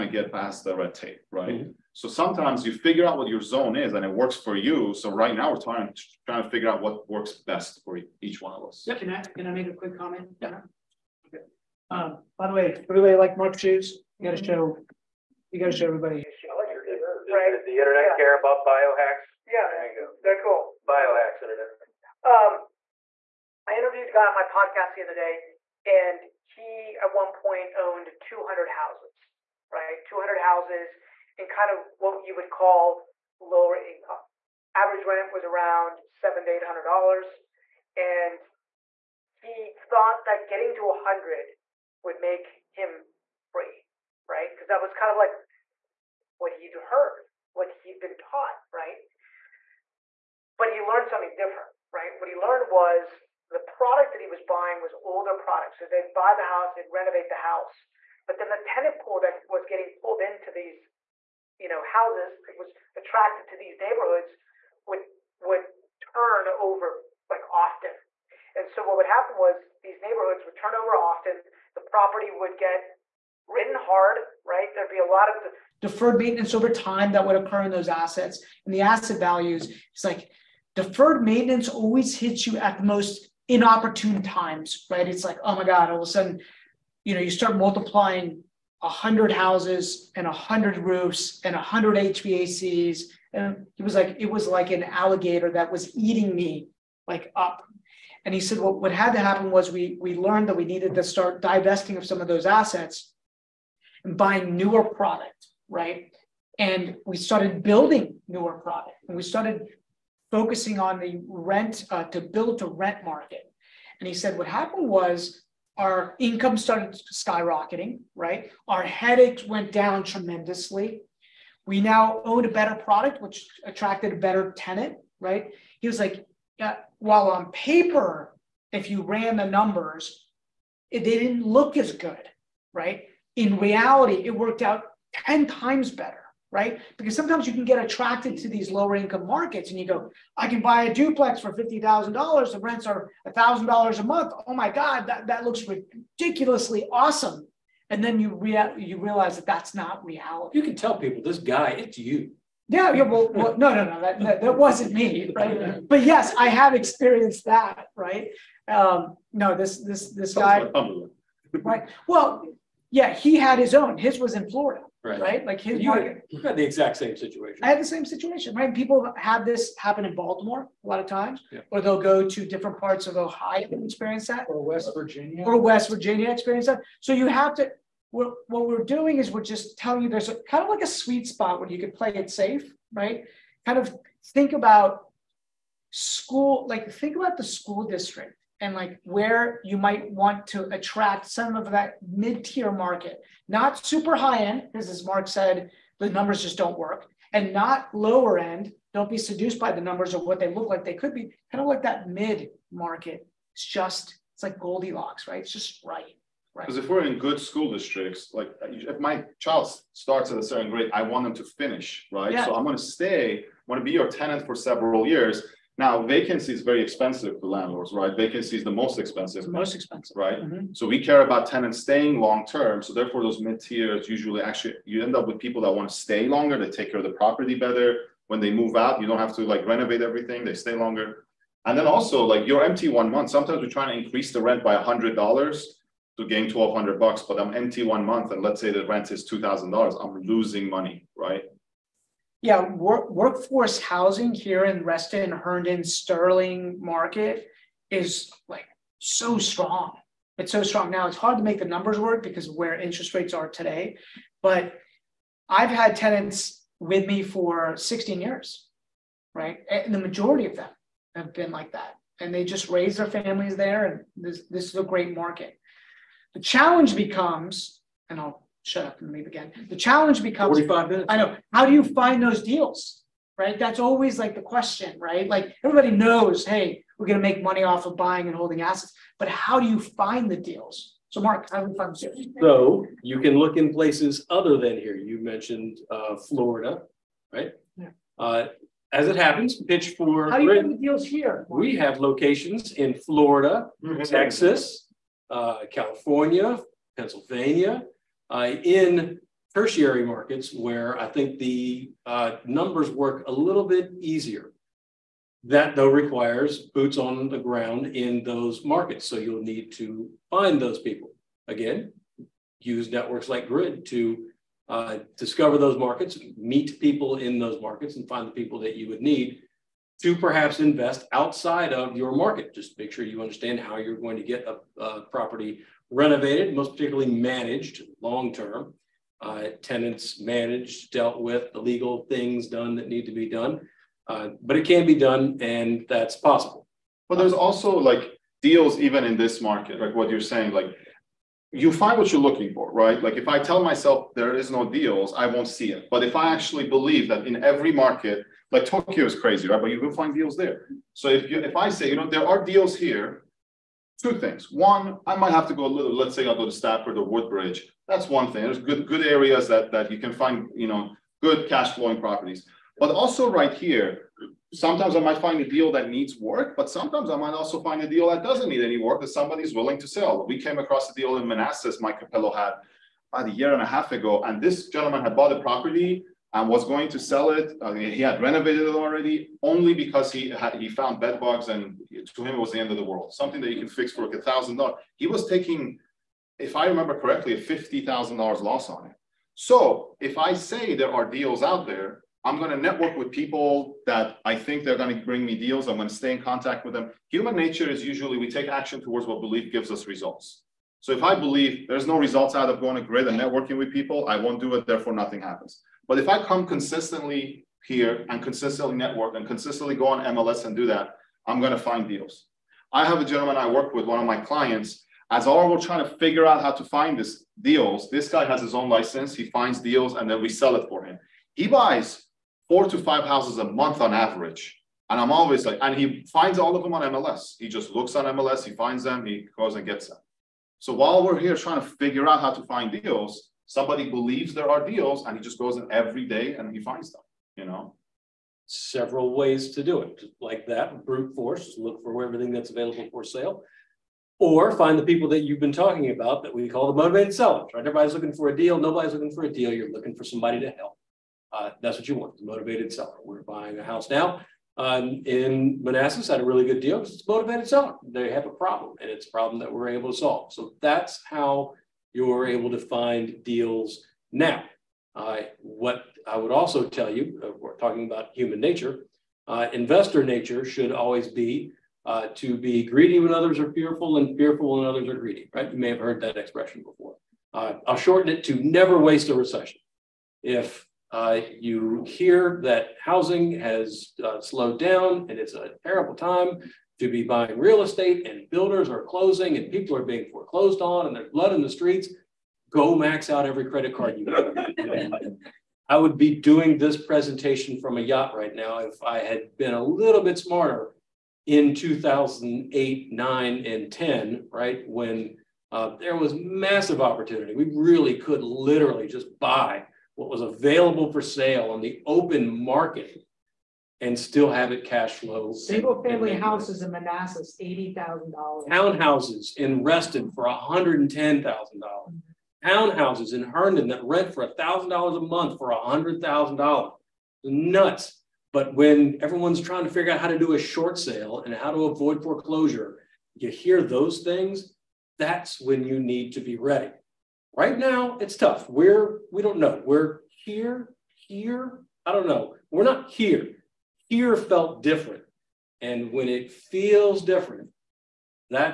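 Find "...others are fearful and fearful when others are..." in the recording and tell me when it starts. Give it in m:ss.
7:53.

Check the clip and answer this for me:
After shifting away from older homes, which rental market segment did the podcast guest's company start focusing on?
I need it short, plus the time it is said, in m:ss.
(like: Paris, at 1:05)
build to rent, at 1:52.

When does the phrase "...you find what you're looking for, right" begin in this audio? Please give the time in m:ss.
5:41.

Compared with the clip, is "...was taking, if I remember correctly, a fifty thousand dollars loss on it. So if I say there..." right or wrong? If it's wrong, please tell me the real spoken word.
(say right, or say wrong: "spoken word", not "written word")
right.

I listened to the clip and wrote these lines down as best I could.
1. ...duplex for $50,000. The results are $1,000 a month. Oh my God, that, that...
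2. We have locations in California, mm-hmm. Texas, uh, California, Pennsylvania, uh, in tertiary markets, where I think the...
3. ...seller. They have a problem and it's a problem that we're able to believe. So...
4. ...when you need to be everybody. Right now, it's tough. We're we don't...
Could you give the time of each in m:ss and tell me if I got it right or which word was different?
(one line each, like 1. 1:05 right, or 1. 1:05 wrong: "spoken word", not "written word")
1. 2:20 wrong: "rents", not "results"
2. 4:51 wrong: "Florida", not "California"
3. 7:37 wrong: "solve", not "believe"
4. 8:55 wrong: "ready", not "everybody".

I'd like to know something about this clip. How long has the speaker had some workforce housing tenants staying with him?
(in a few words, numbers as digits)
16 years.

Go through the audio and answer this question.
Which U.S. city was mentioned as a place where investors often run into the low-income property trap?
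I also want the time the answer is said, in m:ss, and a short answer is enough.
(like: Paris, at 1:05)
Baltimore, at 2:50.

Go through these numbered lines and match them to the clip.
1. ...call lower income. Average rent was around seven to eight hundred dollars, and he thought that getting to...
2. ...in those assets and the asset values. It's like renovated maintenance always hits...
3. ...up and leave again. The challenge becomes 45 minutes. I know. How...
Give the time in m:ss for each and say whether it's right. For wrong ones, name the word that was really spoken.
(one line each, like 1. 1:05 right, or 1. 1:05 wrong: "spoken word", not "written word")
1. 0:32 right
2. 1:17 wrong: "deferred", not "renovated"
3. 4:28 right.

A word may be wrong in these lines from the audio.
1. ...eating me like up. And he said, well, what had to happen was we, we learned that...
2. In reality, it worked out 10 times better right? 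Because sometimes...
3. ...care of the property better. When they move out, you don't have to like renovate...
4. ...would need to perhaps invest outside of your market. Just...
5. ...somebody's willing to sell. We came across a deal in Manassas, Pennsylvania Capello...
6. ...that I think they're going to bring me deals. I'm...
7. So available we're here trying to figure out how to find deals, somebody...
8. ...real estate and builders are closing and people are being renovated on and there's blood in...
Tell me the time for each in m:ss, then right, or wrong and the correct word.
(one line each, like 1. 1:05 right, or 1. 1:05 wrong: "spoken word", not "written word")
1. 1:35 right
2. 2:13 right
3. 3:46 right
4. 5:18 right
5. 6:09 wrong: "Mike", not "Pennsylvania"
6. 6:33 right
7. 7:10 wrong: "while", not "available"
8. 8:07 wrong: "foreclosed", not "renovated".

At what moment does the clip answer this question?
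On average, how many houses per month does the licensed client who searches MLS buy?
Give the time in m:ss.
7:02.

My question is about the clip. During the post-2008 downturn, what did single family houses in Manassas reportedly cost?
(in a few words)
$80,000.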